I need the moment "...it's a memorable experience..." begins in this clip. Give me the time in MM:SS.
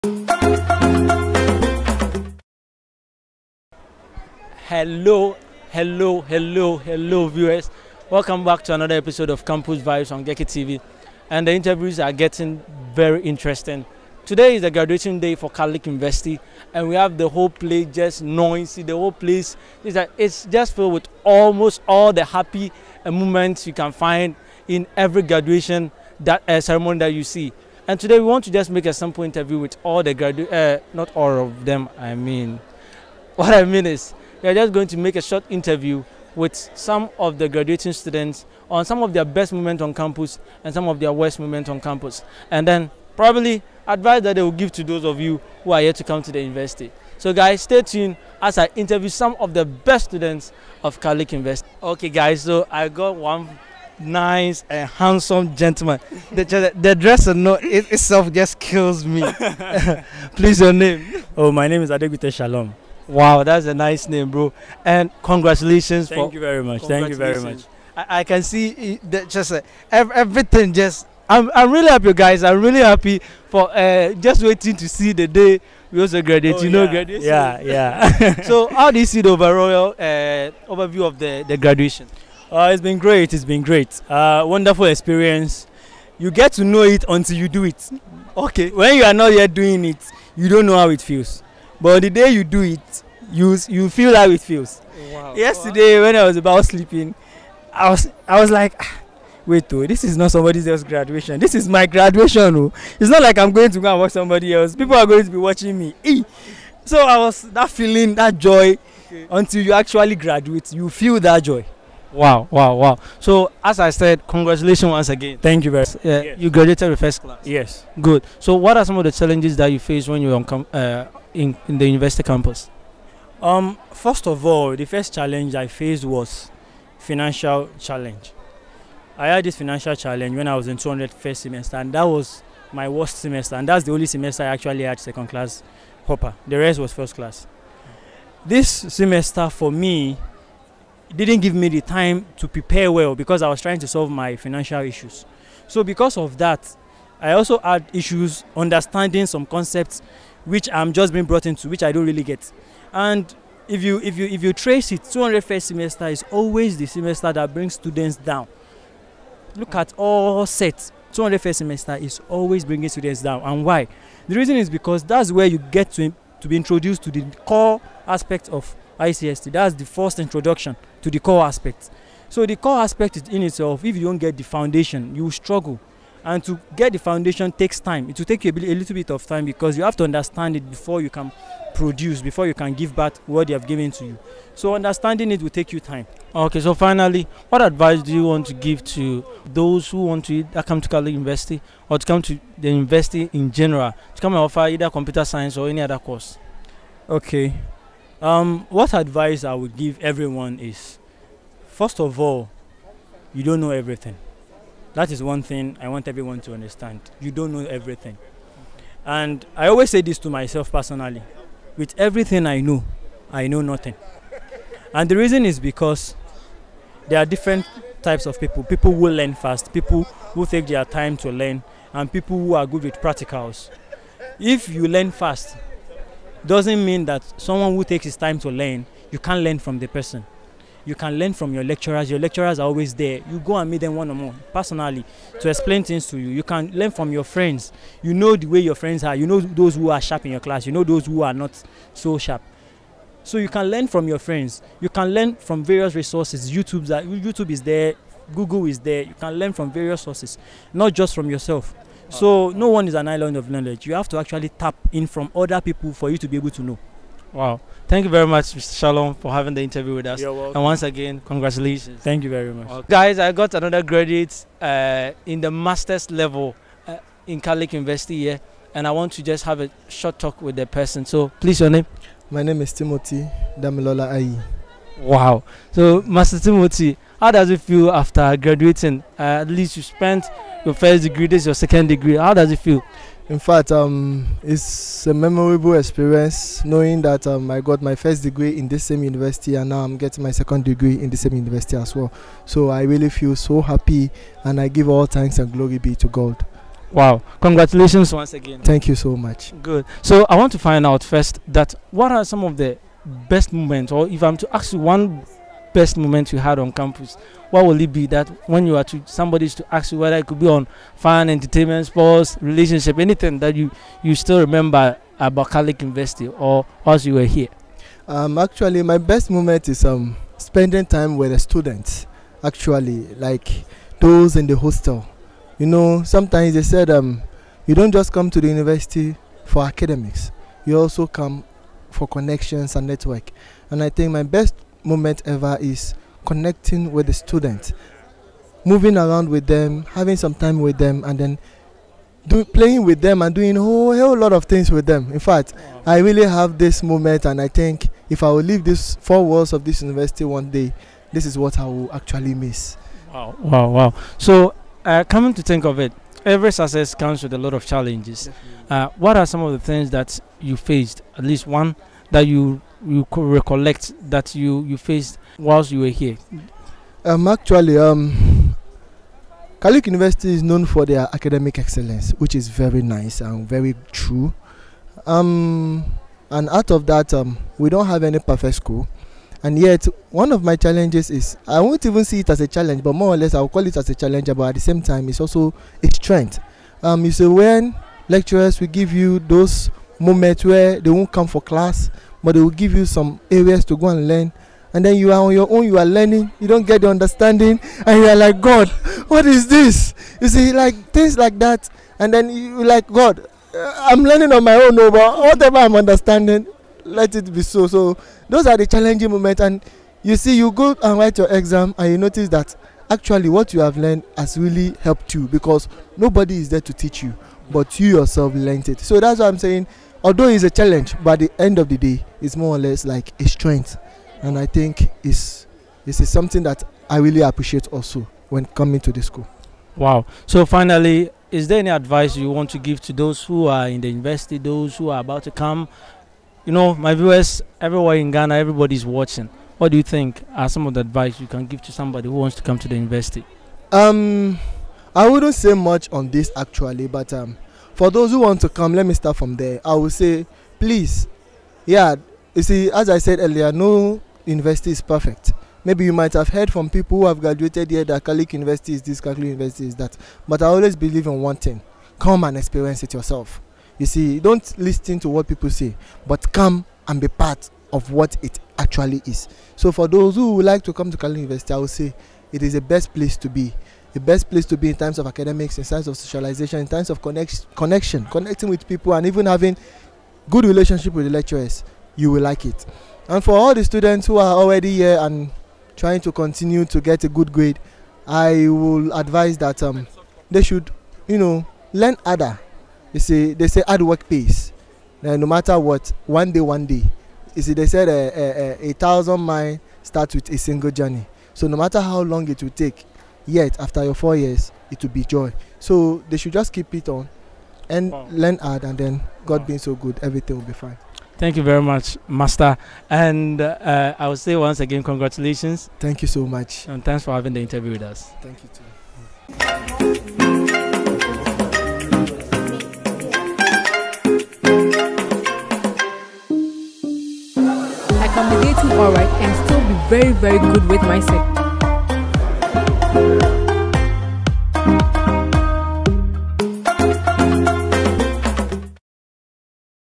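04:44.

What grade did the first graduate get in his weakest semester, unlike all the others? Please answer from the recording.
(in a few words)
Second class upper.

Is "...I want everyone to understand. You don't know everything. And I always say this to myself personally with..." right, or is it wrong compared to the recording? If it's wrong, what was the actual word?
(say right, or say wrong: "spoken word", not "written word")
right.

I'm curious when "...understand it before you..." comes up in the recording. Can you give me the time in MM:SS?
03:00.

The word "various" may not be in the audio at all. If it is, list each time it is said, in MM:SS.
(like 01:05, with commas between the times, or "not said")
04:05, 04:09.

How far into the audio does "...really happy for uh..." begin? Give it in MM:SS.
01:12.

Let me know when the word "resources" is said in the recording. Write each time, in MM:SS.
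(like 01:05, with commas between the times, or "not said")
04:05.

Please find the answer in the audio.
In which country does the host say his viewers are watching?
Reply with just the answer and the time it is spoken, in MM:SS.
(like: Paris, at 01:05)
Ghana, at 07:18.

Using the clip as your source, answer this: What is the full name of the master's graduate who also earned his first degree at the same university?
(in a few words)
Timothy Damilola Ai.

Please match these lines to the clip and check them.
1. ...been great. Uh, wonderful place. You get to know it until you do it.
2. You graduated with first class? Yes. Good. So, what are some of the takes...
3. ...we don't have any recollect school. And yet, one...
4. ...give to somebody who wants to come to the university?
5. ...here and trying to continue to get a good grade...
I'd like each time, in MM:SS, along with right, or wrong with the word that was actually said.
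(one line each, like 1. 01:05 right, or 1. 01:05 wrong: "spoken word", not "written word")
1. 01:23 wrong: "experience", not "place"
2. 01:56 wrong: "challenges", not "takes"
3. 06:17 wrong: "perfect", not "recollect"
4. 07:21 right
5. 08:04 right.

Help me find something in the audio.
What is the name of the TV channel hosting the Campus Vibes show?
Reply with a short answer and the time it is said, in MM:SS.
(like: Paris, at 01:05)
Geky TV, at 00:10.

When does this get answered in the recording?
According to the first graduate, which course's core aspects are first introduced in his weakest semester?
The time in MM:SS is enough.
02:48.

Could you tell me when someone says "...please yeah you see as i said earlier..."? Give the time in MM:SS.
07:30.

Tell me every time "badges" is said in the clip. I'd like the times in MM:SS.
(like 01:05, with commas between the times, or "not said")
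not said.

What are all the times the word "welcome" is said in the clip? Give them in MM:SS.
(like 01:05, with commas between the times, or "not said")
00:08, 04:20.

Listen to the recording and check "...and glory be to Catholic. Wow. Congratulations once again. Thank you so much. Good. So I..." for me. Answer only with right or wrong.
wrong.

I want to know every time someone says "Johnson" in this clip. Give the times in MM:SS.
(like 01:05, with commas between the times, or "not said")
not said.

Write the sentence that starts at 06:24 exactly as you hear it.
But at the same time, it's also a strength.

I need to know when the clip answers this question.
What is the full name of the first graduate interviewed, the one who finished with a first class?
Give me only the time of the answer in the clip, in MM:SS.
01:01.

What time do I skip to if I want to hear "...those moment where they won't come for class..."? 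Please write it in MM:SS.
06:29.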